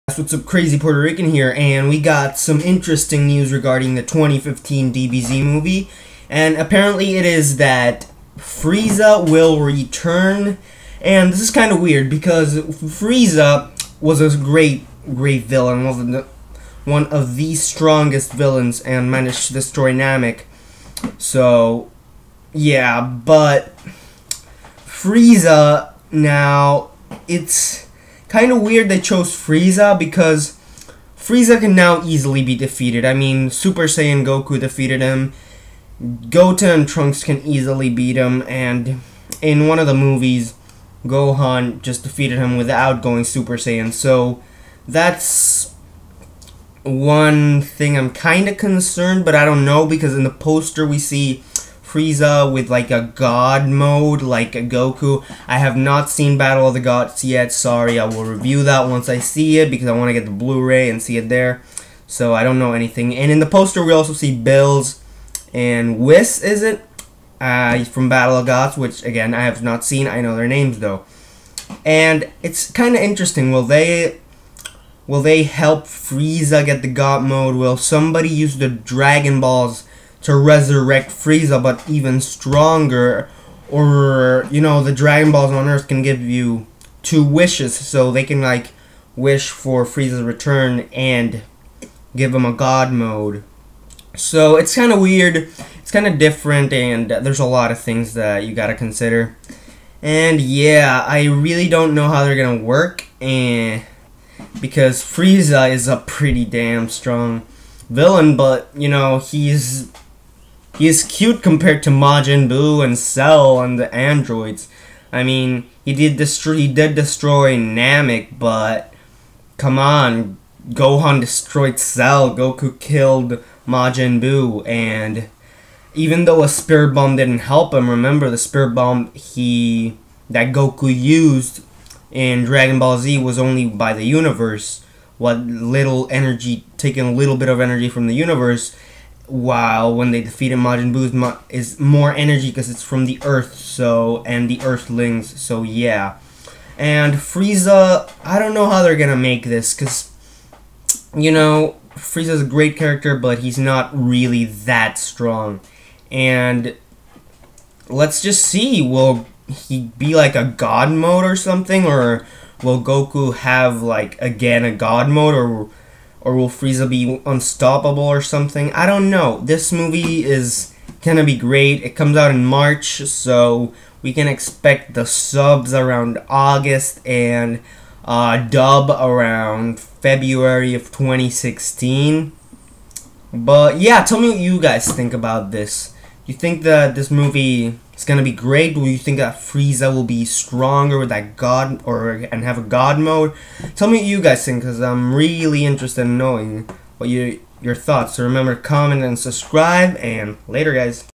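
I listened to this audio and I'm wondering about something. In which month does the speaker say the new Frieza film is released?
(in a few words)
March.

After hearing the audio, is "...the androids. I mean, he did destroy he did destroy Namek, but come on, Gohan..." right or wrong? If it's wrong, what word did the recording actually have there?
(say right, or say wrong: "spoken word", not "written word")
right.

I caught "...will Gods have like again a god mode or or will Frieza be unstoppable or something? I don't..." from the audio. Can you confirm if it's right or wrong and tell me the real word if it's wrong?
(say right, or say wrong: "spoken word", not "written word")
wrong: "Goku", not "Gods".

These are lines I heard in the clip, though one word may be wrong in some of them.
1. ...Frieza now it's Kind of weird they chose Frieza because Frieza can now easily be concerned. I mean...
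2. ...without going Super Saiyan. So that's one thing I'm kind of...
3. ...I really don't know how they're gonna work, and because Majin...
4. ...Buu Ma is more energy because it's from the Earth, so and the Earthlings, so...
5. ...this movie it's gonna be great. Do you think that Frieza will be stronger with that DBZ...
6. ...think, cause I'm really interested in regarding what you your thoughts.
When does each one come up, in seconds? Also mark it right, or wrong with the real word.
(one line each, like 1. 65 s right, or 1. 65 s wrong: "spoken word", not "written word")
1. 24 s wrong: "defeated", not "concerned"
2. 42 s right
3. 101 s wrong: "Frieza", not "Majin"
4. 140 s right
5. 186 s wrong: "God", not "DBZ"
6. 194 s wrong: "knowing", not "regarding".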